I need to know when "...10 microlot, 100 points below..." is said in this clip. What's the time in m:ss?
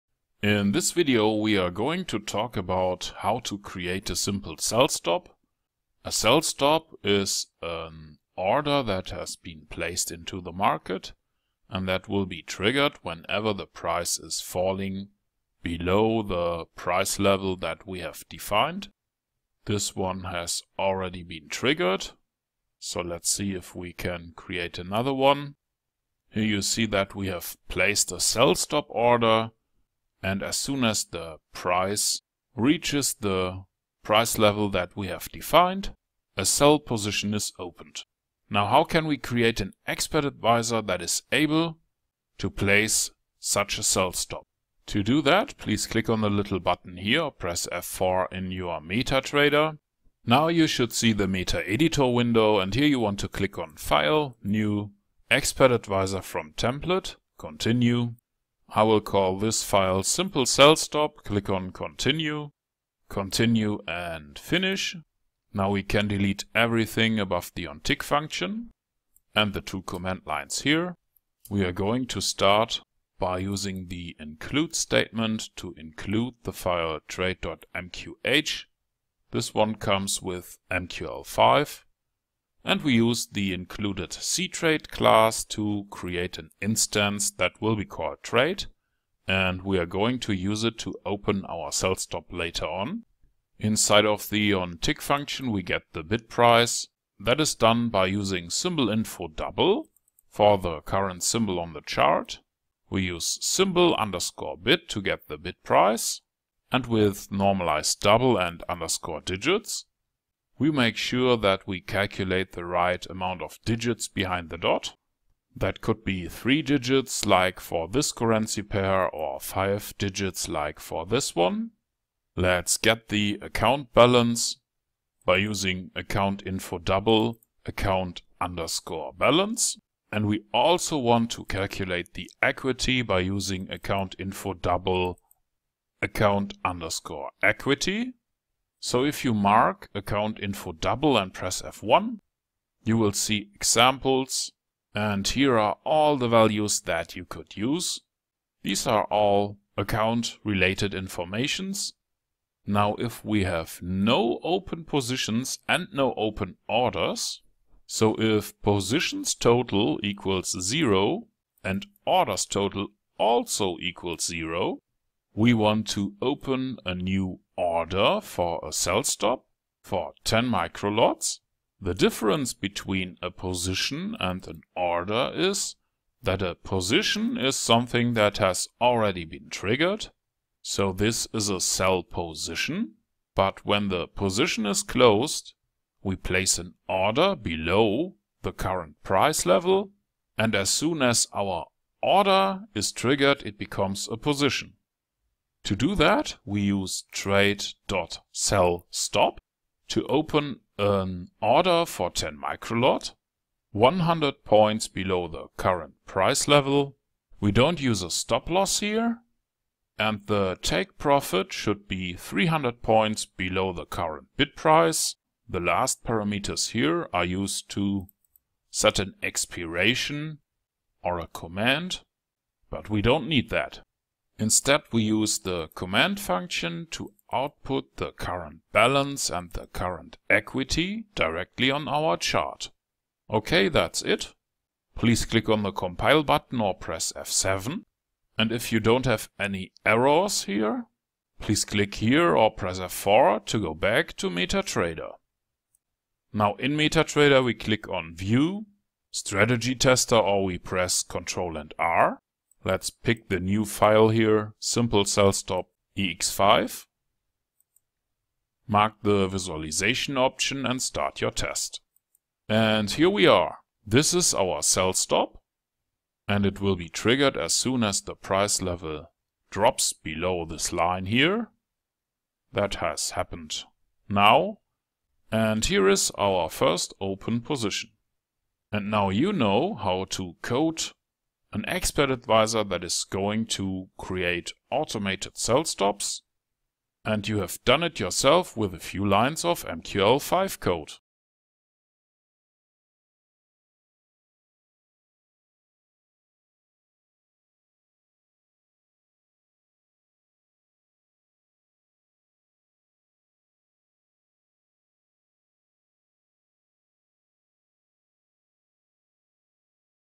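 3:22.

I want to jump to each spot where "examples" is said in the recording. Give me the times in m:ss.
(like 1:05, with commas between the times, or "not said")
2:23.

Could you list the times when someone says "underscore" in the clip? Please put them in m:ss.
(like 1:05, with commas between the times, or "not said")
1:43, 1:48, 2:08, 2:16.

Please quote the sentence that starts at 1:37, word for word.
That is done by using symbol info double for the current symbol on the chart.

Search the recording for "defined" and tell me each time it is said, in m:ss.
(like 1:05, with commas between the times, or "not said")
0:18, 0:35.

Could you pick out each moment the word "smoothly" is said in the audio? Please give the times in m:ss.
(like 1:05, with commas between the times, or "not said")
not said.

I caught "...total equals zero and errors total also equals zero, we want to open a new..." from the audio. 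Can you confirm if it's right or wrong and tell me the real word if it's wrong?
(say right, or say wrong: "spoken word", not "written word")
wrong: "orders", not "errors".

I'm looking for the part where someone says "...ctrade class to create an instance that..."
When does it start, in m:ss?
1:24.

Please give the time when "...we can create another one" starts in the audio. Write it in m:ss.
0:23.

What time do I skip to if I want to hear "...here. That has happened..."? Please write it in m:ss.
4:31.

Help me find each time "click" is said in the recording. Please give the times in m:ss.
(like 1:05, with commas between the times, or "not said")
0:45, 0:53, 1:01, 3:55, 4:01, 4:07.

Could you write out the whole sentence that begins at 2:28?
These are all account related informations.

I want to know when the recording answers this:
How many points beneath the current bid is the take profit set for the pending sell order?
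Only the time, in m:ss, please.
3:32.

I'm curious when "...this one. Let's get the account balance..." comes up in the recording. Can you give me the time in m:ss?
2:01.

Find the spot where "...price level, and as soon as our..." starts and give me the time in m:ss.
3:09.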